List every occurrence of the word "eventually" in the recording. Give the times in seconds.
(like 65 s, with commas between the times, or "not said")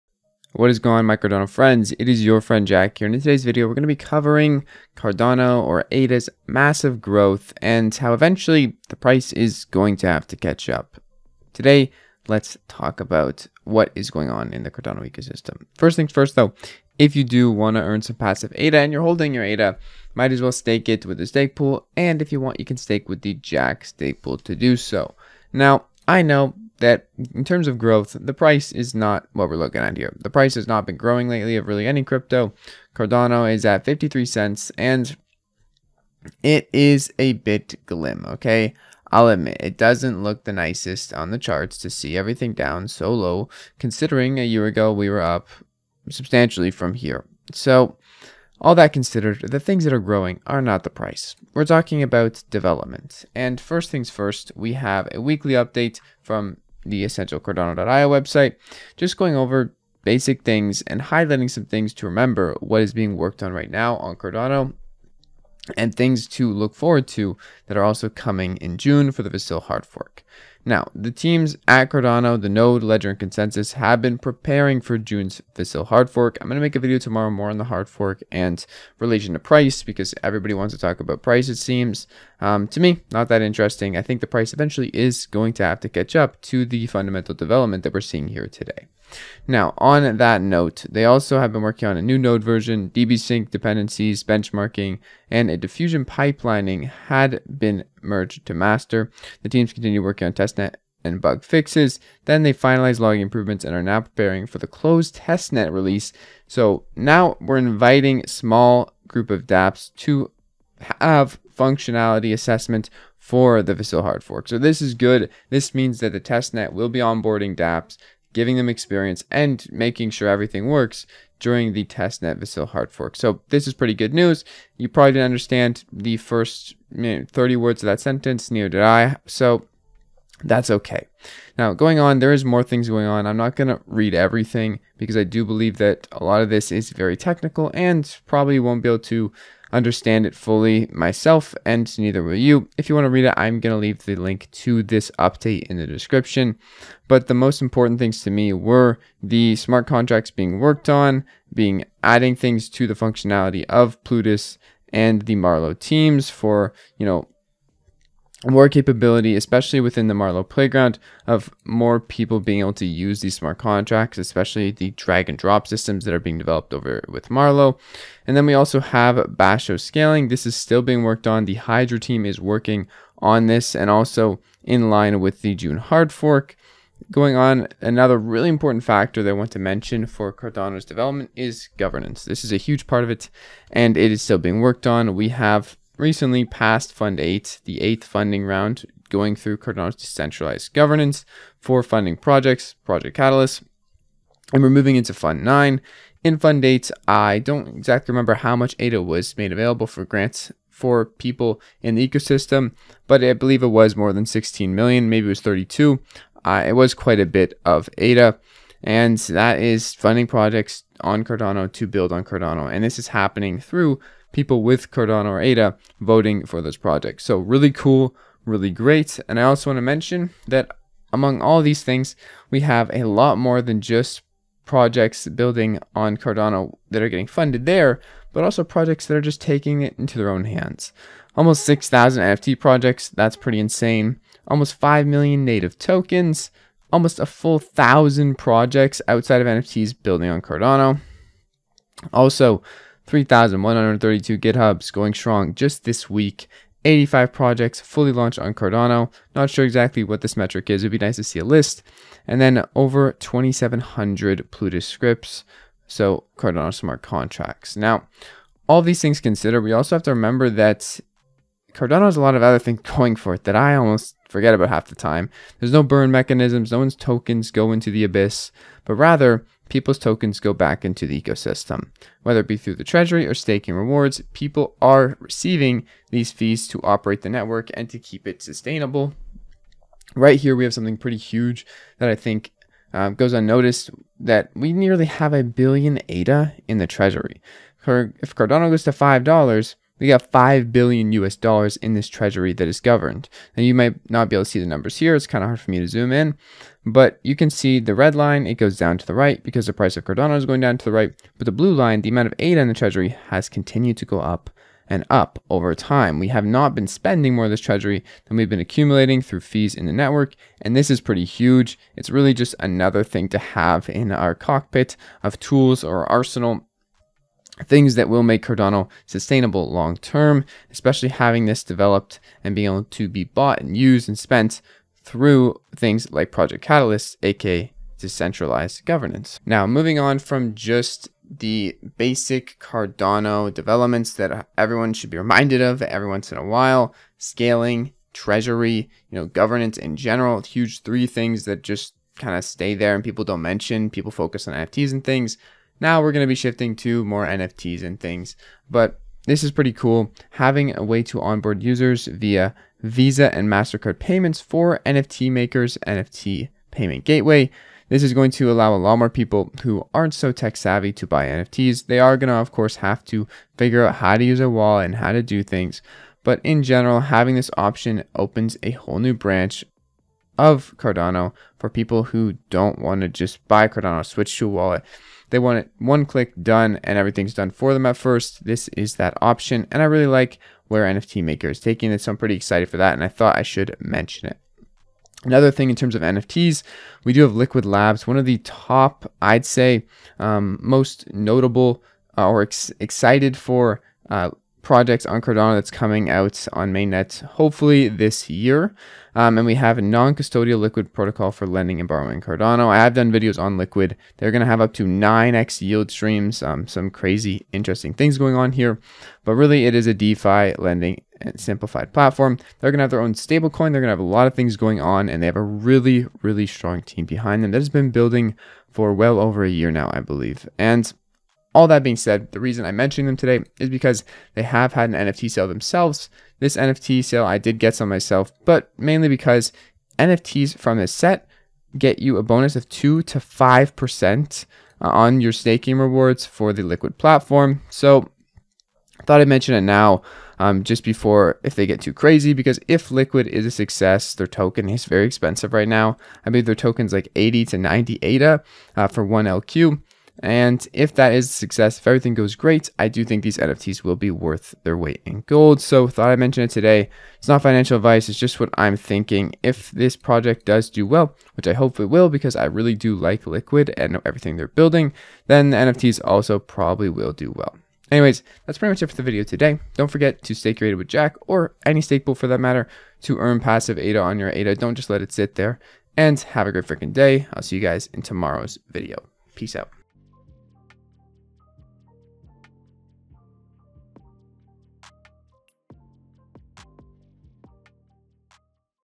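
8 s, 84 s.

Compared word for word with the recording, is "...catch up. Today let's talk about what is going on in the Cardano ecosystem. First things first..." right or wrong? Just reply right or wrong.
right.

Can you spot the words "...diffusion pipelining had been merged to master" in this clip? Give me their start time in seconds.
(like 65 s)
95 s.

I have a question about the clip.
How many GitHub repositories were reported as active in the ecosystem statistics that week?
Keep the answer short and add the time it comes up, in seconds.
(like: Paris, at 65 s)
3,132, at 243 s.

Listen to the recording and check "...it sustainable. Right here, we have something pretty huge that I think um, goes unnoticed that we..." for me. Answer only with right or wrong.
right.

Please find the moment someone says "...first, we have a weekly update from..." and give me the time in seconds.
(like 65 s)
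54 s.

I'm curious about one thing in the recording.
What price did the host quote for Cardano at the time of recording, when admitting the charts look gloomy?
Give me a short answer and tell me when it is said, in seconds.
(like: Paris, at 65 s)
53 cents, at 33 s.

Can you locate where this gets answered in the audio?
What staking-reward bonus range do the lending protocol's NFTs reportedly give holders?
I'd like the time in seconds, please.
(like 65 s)
432 s.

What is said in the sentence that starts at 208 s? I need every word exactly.
And that is funding projects on Cardano to build on Cardano.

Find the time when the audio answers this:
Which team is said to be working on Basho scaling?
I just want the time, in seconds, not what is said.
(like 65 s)
171 s.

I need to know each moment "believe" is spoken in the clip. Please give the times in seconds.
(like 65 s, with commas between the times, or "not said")
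135 s, 203 s, 419 s, 446 s.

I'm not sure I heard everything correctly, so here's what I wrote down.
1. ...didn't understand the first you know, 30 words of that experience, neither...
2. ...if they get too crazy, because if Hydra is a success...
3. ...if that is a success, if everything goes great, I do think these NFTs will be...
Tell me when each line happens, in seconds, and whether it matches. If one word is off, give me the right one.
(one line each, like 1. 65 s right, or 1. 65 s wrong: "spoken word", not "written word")
1. 125 s wrong: "sentence", not "experience"
2. 441 s wrong: "Liqwid", not "Hydra"
3. 450 s right.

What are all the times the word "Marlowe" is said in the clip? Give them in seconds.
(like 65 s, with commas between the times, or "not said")
155 s, 160 s, 167 s.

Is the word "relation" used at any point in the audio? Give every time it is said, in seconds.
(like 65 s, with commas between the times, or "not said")
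78 s.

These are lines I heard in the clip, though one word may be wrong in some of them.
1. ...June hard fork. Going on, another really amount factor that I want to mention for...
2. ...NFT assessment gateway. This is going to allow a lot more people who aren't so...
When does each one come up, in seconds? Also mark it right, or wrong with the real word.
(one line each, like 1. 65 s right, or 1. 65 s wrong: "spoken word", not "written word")
1. 175 s wrong: "important", not "amount"
2. 355 s wrong: "payment", not "assessment".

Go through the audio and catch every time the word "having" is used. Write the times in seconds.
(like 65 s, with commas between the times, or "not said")
321 s, 350 s, 367 s.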